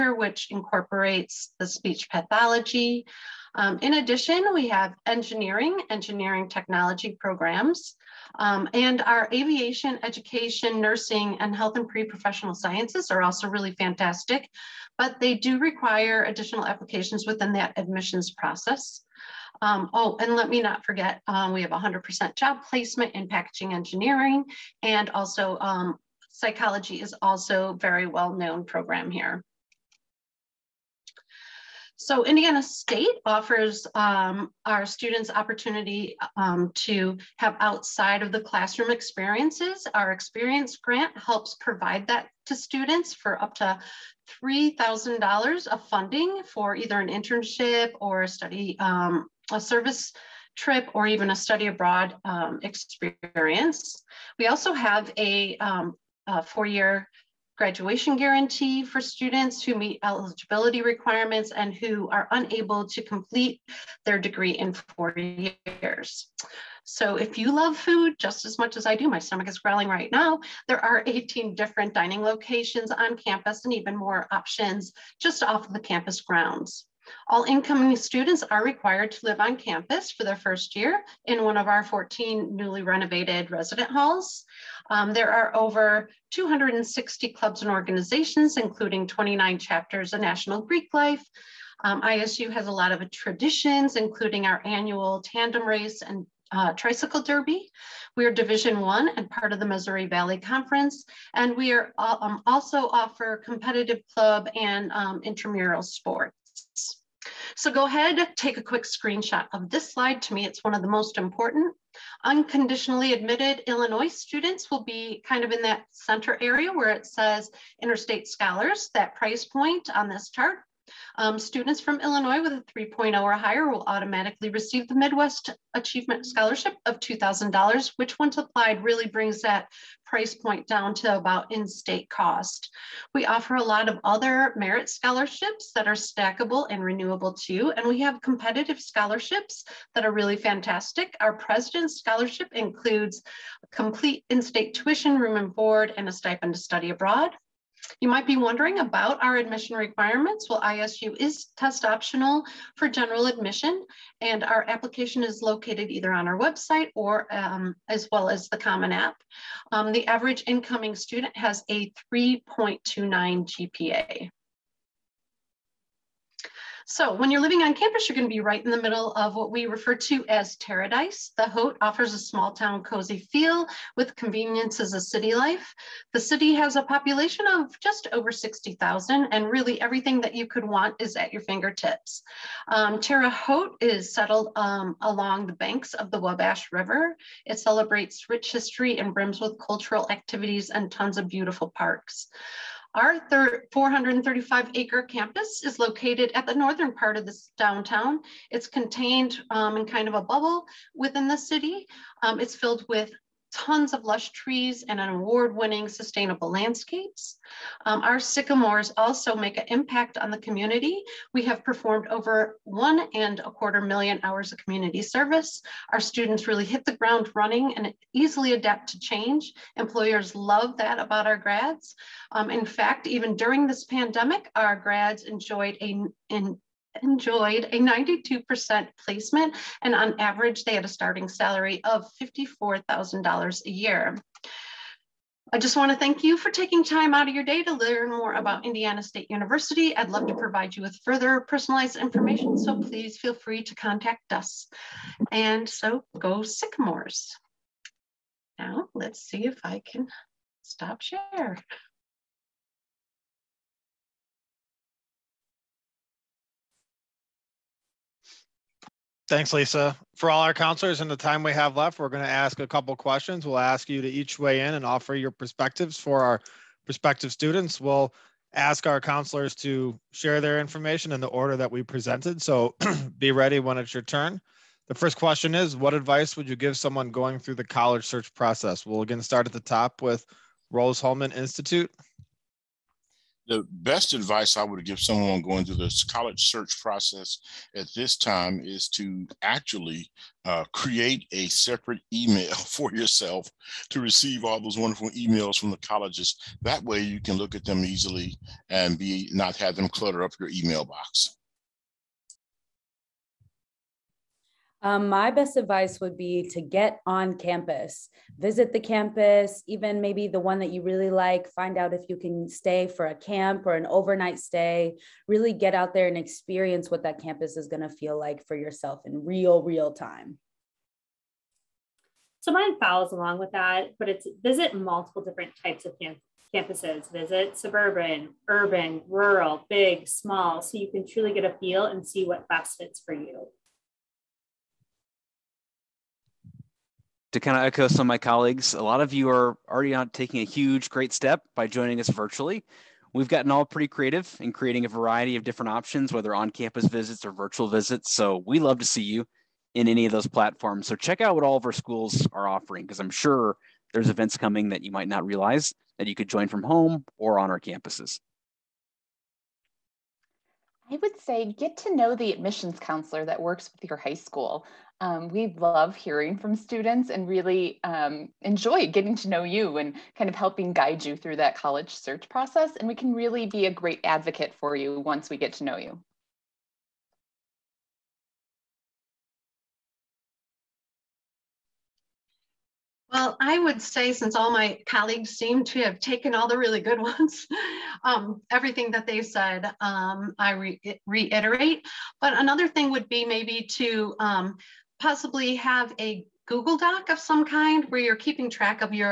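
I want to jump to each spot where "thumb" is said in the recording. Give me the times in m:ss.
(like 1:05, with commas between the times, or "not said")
not said.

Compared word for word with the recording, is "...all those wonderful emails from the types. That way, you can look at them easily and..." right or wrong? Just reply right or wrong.
wrong.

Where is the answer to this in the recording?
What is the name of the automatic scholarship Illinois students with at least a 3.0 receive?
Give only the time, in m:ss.
2:04.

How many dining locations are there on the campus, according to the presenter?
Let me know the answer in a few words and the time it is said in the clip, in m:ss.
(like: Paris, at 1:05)
18, at 1:11.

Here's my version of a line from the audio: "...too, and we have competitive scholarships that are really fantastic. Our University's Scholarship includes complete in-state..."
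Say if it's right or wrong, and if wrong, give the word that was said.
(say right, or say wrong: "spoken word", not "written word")
wrong: "President", not "University".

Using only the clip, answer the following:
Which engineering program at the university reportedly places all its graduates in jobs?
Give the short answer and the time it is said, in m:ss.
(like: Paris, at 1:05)
Packaging engineering, at 0:23.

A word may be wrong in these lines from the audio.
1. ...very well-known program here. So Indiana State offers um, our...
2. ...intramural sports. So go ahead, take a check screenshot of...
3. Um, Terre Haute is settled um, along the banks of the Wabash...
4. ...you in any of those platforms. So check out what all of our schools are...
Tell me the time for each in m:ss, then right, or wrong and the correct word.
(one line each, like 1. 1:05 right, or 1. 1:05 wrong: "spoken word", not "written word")
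1. 0:27 right
2. 1:45 wrong: "quick", not "check"
3. 3:02 right
4. 5:49 right.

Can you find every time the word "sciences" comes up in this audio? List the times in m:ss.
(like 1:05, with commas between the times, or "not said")
0:12.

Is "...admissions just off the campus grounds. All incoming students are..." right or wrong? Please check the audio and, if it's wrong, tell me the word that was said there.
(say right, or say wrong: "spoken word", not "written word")
wrong: "options", not "admissions".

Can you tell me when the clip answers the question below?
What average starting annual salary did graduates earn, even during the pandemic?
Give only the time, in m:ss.
3:52.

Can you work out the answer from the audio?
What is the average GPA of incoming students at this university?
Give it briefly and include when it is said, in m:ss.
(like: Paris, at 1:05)
3.29, at 2:42.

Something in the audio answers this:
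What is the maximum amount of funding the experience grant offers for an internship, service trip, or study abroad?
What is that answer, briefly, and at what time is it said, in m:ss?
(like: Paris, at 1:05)
$3,000, at 0:44.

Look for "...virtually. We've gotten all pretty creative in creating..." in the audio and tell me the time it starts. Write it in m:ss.
5:42.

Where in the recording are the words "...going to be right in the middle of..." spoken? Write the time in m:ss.
2:48.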